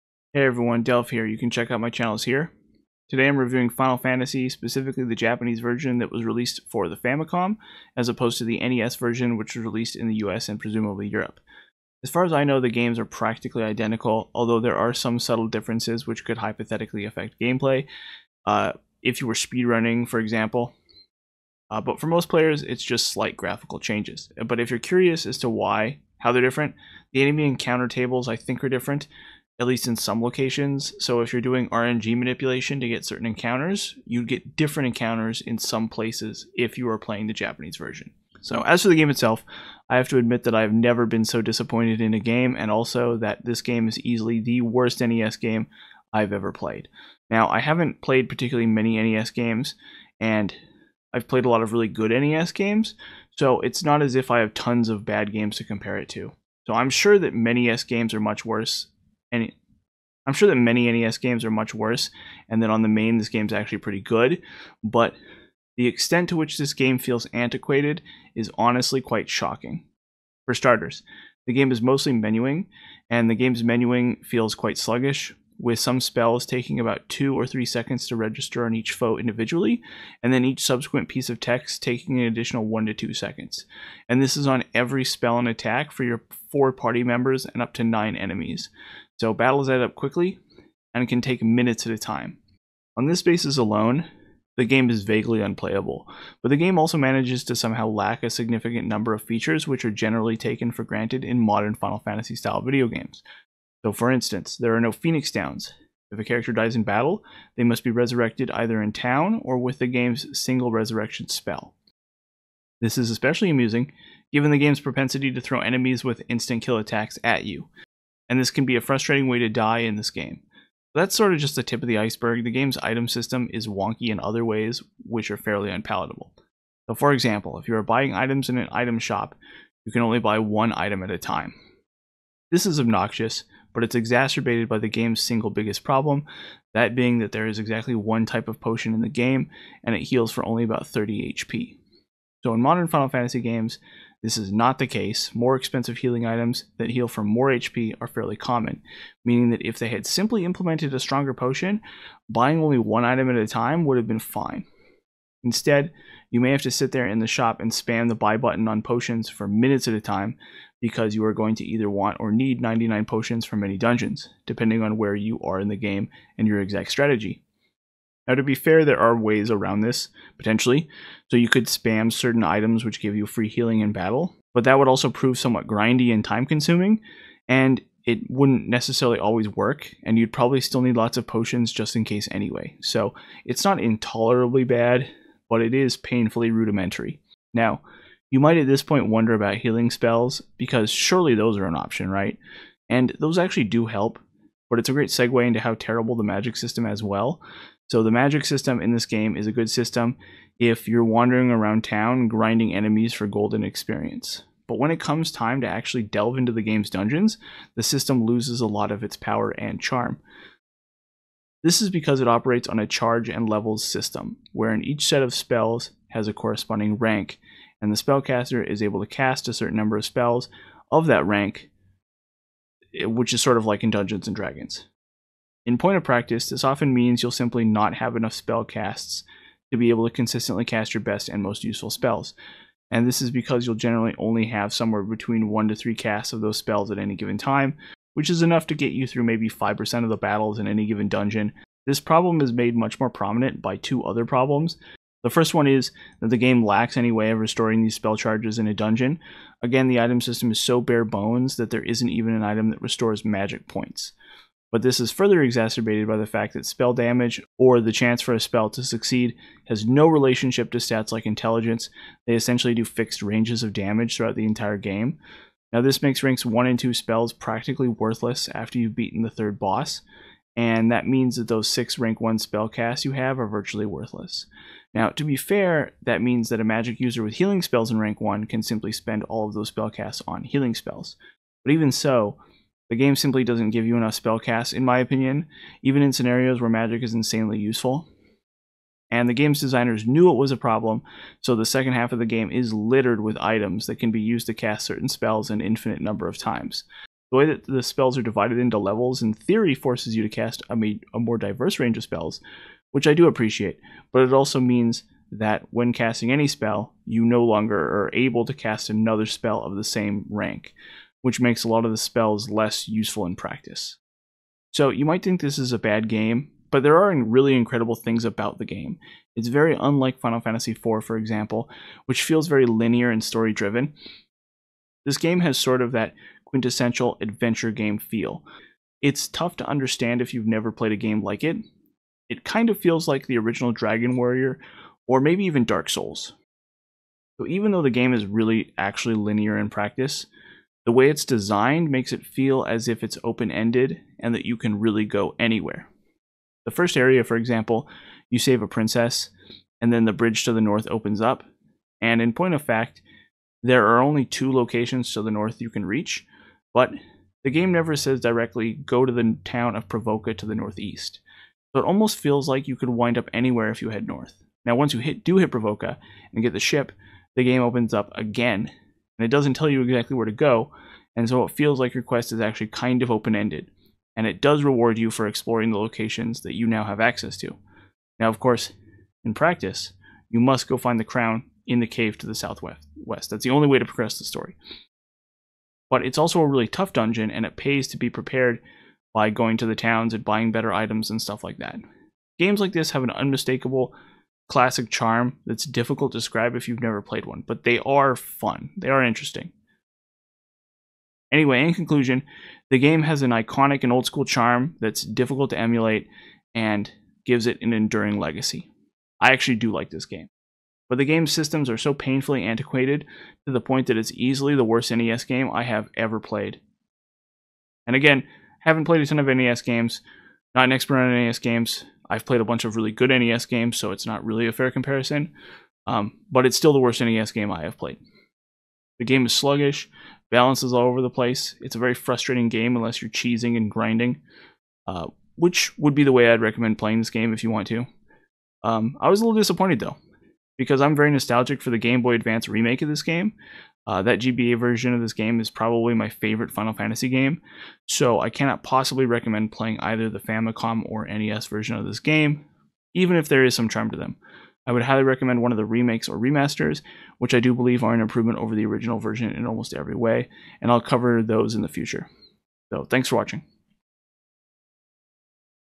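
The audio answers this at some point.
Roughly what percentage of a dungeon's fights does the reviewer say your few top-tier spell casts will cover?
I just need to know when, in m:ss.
3:59.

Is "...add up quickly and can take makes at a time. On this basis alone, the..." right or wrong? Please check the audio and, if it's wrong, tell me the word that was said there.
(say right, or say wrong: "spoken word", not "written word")
wrong: "minutes", not "makes".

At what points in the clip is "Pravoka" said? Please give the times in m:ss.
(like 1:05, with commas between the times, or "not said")
5:59, 6:05.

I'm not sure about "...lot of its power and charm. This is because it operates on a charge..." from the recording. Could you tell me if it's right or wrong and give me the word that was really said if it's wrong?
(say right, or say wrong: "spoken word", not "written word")
right.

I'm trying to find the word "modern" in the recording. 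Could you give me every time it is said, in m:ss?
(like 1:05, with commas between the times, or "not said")
1:41, 2:22.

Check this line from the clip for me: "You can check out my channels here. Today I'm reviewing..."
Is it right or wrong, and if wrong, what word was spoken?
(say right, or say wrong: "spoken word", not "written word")
right.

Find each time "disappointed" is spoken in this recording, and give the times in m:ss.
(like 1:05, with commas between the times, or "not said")
0:41, 7:19.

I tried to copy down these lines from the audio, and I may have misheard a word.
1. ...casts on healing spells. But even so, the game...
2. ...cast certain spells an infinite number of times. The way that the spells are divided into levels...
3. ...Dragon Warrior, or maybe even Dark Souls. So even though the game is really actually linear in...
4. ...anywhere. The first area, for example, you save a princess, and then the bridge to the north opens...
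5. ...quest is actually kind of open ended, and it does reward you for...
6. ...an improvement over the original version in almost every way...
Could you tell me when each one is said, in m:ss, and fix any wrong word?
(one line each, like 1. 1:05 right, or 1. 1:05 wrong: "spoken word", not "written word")
1. 4:39 wrong: "spellcasts", not "casts"
2. 4:54 right
3. 5:33 right
4. 5:45 right
5. 6:12 right
6. 7:37 right.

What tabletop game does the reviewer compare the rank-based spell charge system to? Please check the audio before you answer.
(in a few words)
Dungeons and Dragons.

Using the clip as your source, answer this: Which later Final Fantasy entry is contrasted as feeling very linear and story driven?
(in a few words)
Final Fantasy IV.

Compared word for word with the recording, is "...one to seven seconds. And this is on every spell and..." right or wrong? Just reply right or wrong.
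wrong.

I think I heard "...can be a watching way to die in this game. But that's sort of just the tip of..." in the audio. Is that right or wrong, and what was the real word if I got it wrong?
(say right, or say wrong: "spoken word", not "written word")
wrong: "frustrating", not "watching".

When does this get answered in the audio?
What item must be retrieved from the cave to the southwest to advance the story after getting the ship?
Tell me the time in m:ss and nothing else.
6:20.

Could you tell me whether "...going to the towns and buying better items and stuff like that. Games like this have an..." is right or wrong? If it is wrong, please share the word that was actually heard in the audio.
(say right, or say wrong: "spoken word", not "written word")
right.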